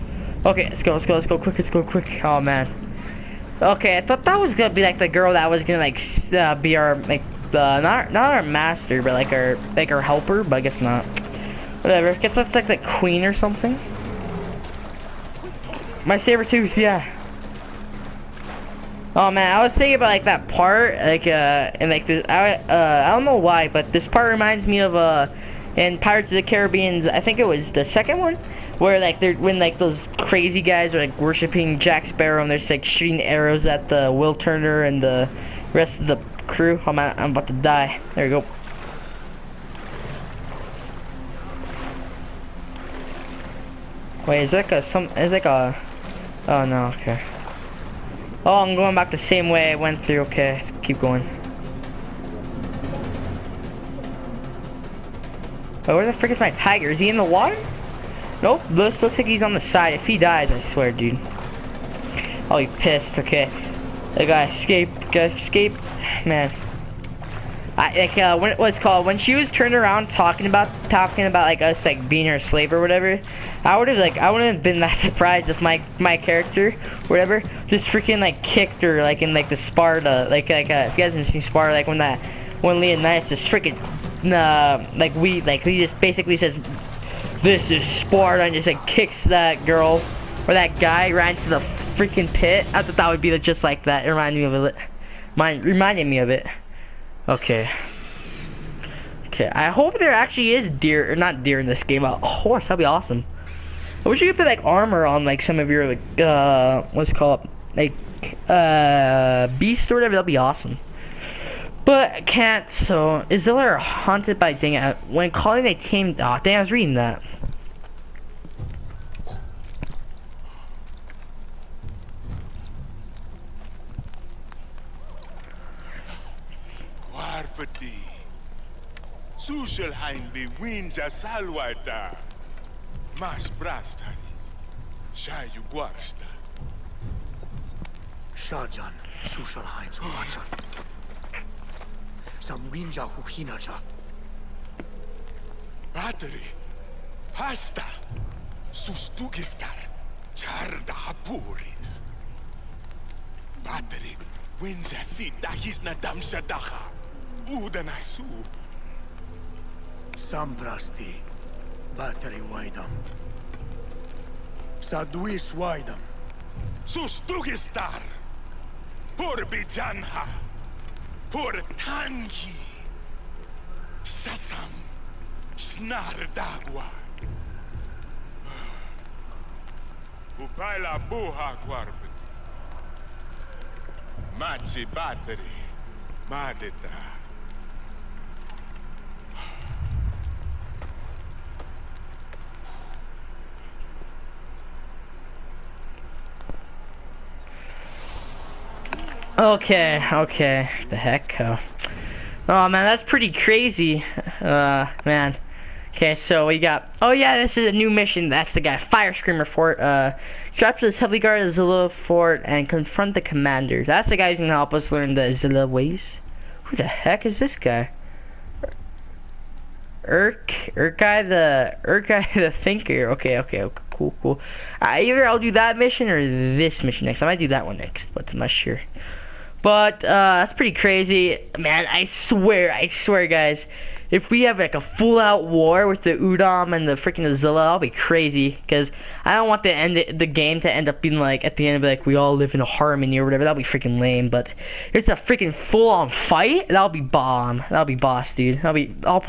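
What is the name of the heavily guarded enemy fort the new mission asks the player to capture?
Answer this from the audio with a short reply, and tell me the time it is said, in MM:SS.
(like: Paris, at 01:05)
Fire Screamer Fort, at 03:28.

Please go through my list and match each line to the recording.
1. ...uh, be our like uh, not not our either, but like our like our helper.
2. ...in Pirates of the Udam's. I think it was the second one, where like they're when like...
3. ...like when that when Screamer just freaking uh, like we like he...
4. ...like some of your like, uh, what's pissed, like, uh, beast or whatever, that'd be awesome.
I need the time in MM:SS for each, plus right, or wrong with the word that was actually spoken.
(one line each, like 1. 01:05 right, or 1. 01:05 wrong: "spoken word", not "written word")
1. 00:06 wrong: "master", not "either"
2. 00:25 wrong: "Caribbean", not "Udam"
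3. 01:21 wrong: "Leonidas", not "Screamer"
4. 01:45 wrong: "called", not "pissed".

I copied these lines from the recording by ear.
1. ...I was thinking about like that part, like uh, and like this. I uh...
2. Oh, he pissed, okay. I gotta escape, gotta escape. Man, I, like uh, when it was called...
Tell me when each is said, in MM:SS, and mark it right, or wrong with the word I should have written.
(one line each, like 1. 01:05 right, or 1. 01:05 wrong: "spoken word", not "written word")
1. 00:19 right
2. 01:02 right.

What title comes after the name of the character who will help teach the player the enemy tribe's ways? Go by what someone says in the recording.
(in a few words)
the Thinker.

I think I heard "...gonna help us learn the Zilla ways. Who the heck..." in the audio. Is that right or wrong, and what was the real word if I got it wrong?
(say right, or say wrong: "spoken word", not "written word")
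right.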